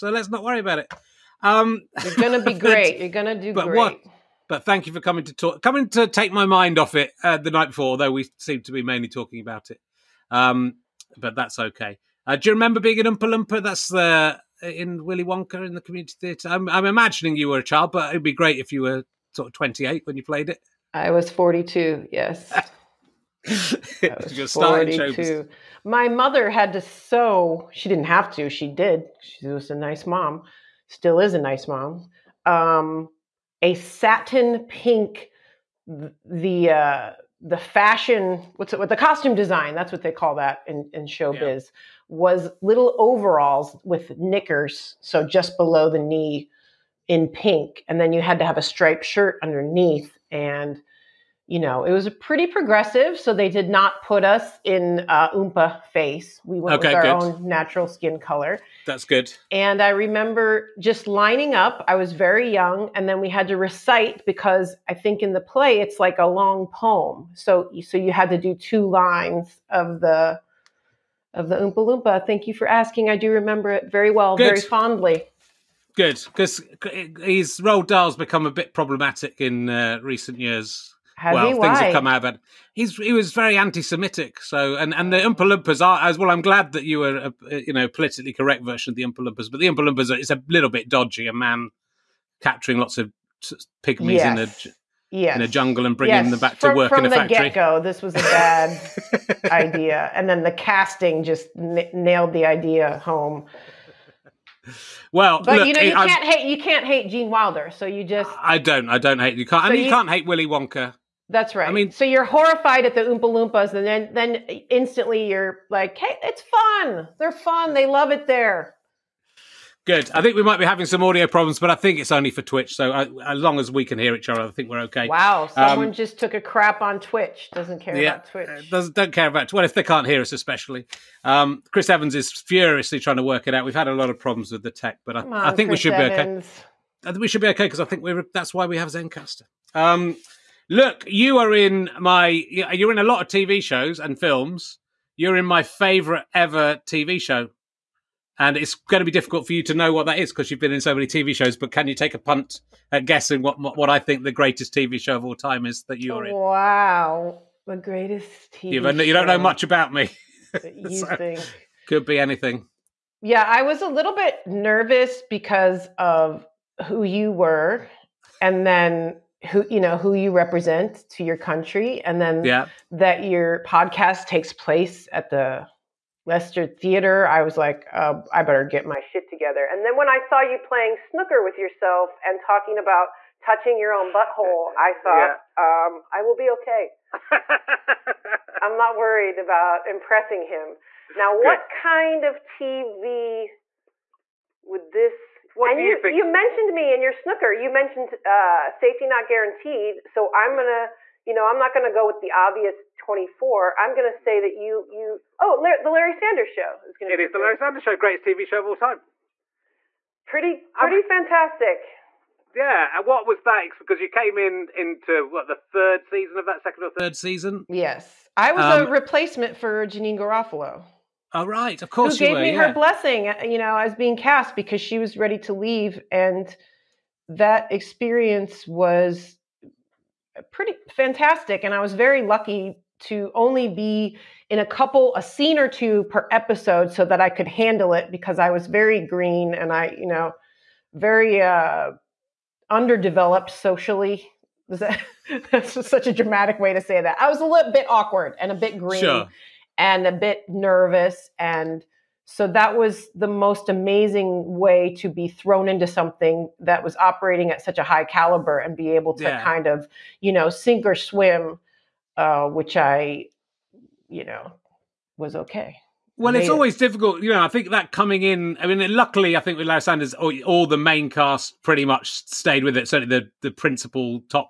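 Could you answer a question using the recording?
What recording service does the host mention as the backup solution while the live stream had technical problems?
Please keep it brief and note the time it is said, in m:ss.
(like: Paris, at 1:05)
Zencastr, at 2:18.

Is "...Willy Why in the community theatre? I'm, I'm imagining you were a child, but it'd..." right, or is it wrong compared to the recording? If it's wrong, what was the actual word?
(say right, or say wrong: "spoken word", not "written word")
wrong: "Wonka", not "Why".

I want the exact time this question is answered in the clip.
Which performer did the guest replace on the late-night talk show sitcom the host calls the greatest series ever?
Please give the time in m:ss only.
3:39.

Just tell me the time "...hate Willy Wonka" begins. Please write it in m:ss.
1:50.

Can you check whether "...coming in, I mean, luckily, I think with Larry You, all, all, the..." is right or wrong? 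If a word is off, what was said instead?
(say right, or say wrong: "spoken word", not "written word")
wrong: "Sanders", not "You".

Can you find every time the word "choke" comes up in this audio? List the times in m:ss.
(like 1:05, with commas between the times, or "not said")
not said.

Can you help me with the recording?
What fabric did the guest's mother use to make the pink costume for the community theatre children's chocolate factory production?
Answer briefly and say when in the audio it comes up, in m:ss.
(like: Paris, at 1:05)
Satin, at 0:33.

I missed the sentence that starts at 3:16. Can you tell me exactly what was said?
You mentioned me in your snooker.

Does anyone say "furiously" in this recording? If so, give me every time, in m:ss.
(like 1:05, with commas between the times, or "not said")
2:12.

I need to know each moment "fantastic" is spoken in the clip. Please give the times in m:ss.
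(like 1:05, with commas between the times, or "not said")
3:31, 3:50.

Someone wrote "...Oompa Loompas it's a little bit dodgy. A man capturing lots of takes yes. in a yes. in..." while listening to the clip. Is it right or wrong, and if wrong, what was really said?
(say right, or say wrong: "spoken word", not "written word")
wrong: "pygmies", not "takes".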